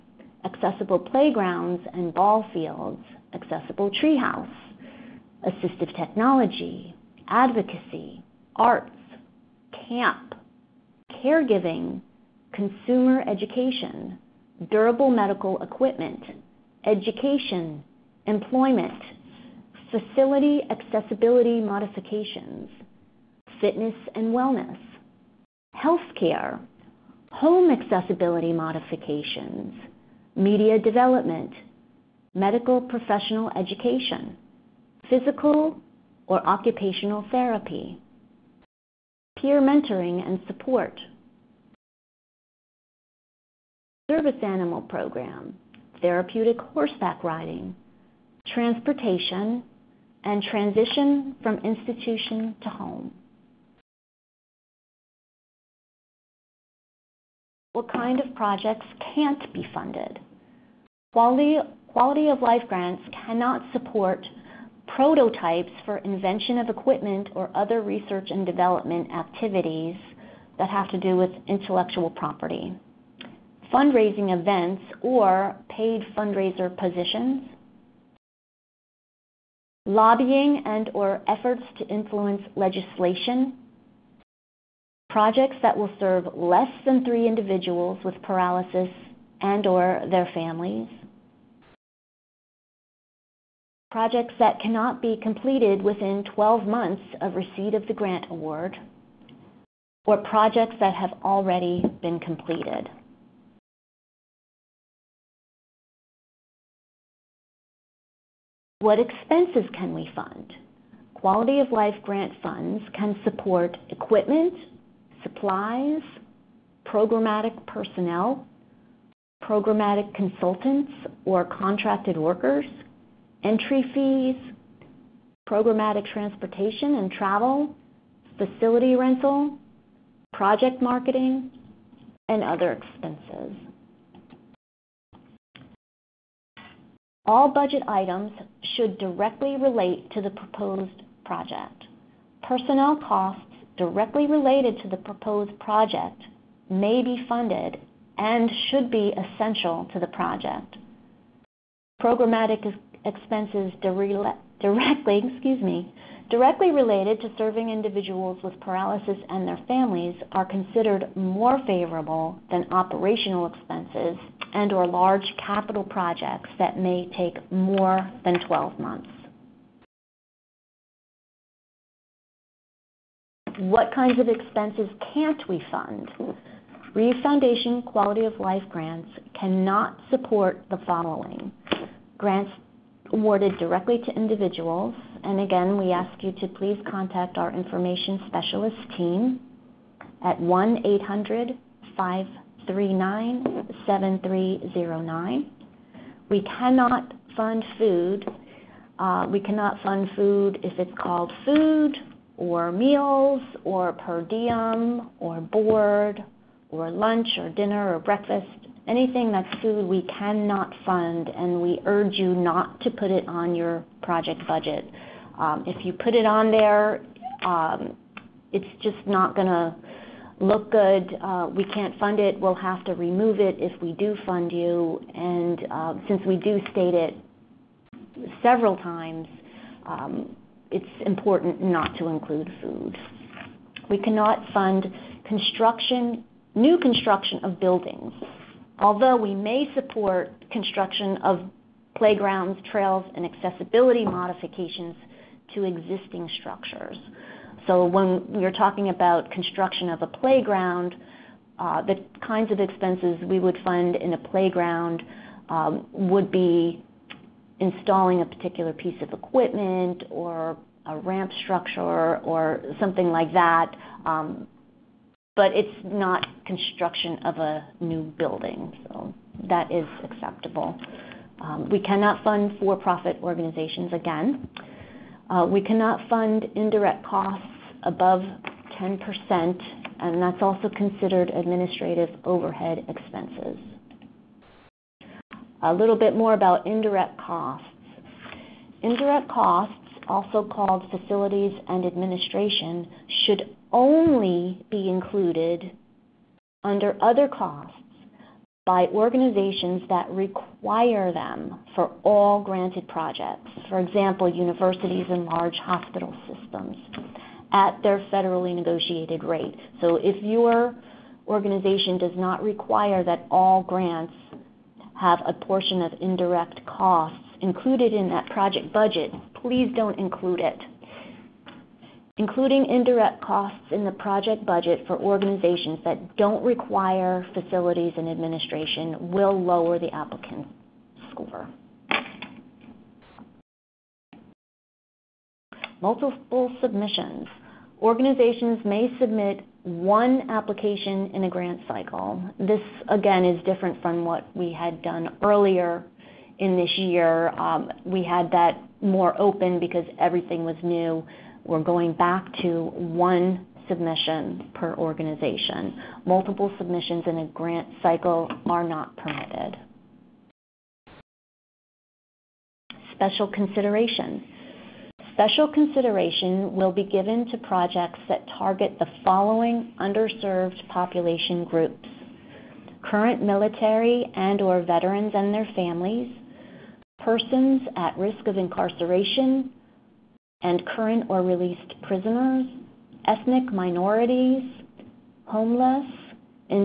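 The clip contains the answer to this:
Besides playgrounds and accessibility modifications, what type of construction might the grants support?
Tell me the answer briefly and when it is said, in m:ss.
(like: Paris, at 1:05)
trails, at 4:02.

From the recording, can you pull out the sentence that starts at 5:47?
Um, we had that more open because everything was new we're going back to one submission per organization.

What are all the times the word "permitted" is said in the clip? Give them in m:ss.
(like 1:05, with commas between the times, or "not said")
5:58.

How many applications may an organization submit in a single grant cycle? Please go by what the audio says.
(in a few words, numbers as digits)
1.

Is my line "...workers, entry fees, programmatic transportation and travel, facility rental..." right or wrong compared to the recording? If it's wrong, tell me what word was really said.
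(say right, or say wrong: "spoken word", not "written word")
right.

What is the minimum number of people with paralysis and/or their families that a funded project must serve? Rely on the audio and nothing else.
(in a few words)
3.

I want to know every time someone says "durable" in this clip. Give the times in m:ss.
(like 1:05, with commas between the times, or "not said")
0:14.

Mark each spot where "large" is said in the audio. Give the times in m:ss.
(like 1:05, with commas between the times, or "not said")
2:44, 5:05.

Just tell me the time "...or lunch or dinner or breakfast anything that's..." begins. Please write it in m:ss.
3:26.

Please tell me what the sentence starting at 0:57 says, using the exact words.
What kind of projects can't be funded?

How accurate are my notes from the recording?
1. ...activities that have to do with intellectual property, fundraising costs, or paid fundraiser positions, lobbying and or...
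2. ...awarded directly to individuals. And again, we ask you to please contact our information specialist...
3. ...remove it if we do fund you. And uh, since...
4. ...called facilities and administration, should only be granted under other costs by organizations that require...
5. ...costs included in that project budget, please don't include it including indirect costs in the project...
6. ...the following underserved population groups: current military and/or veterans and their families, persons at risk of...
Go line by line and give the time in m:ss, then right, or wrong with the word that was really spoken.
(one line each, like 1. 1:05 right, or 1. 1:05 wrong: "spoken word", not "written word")
1. 1:09 wrong: "events", not "costs"
2. 3:03 right
3. 3:42 right
4. 4:50 wrong: "included", not "granted"
5. 5:16 right
6. 6:08 right.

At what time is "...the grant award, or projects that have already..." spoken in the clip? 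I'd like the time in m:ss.
1:37.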